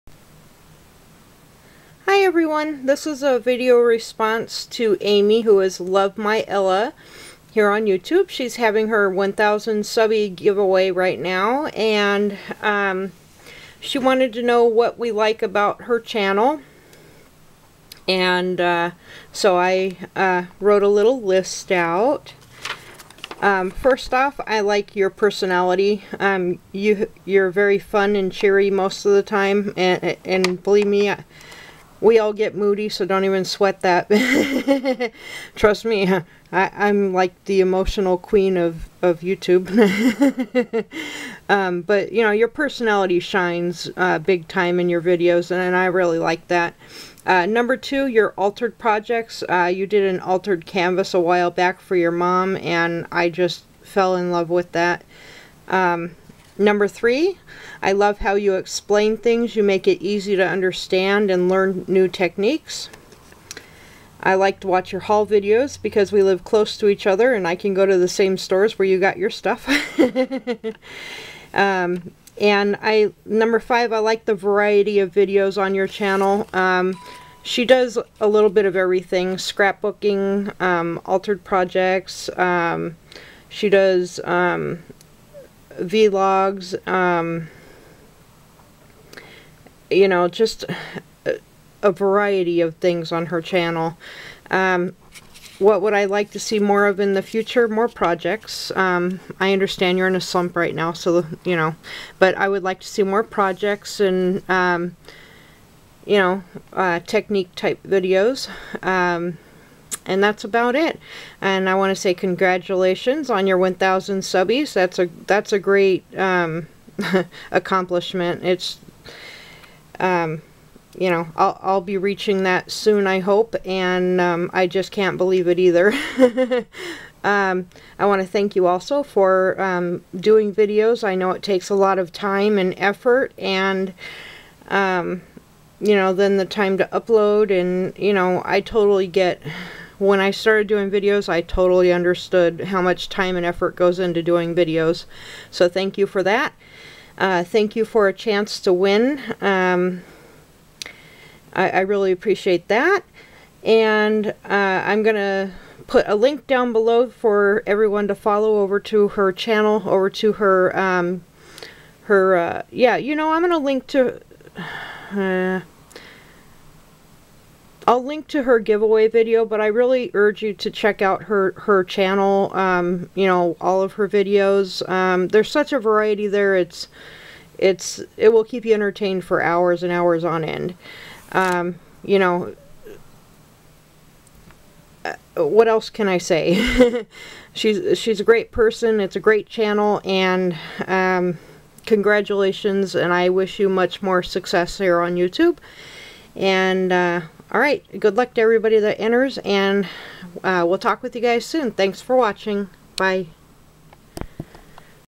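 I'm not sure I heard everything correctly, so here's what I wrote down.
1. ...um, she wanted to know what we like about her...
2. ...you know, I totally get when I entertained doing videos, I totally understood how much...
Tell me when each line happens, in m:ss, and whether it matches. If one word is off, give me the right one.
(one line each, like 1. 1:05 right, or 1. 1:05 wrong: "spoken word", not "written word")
1. 0:12 right
2. 2:17 wrong: "started", not "entertained".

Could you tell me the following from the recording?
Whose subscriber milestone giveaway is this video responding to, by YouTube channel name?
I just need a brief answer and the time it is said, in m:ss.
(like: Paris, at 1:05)
Love My Ella, at 0:05.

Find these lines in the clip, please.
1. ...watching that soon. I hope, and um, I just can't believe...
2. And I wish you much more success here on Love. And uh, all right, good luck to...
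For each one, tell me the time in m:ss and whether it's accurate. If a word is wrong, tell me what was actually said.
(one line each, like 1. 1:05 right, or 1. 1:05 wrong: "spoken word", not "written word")
1. 2:01 wrong: "reaching", not "watching"
2. 3:12 wrong: "YouTube", not "Love".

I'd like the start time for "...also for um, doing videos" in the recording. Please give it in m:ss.
2:08.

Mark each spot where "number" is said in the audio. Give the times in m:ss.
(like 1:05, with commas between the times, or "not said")
0:47, 0:56, 1:13.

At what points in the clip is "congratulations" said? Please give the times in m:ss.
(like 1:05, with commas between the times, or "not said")
1:52, 3:11.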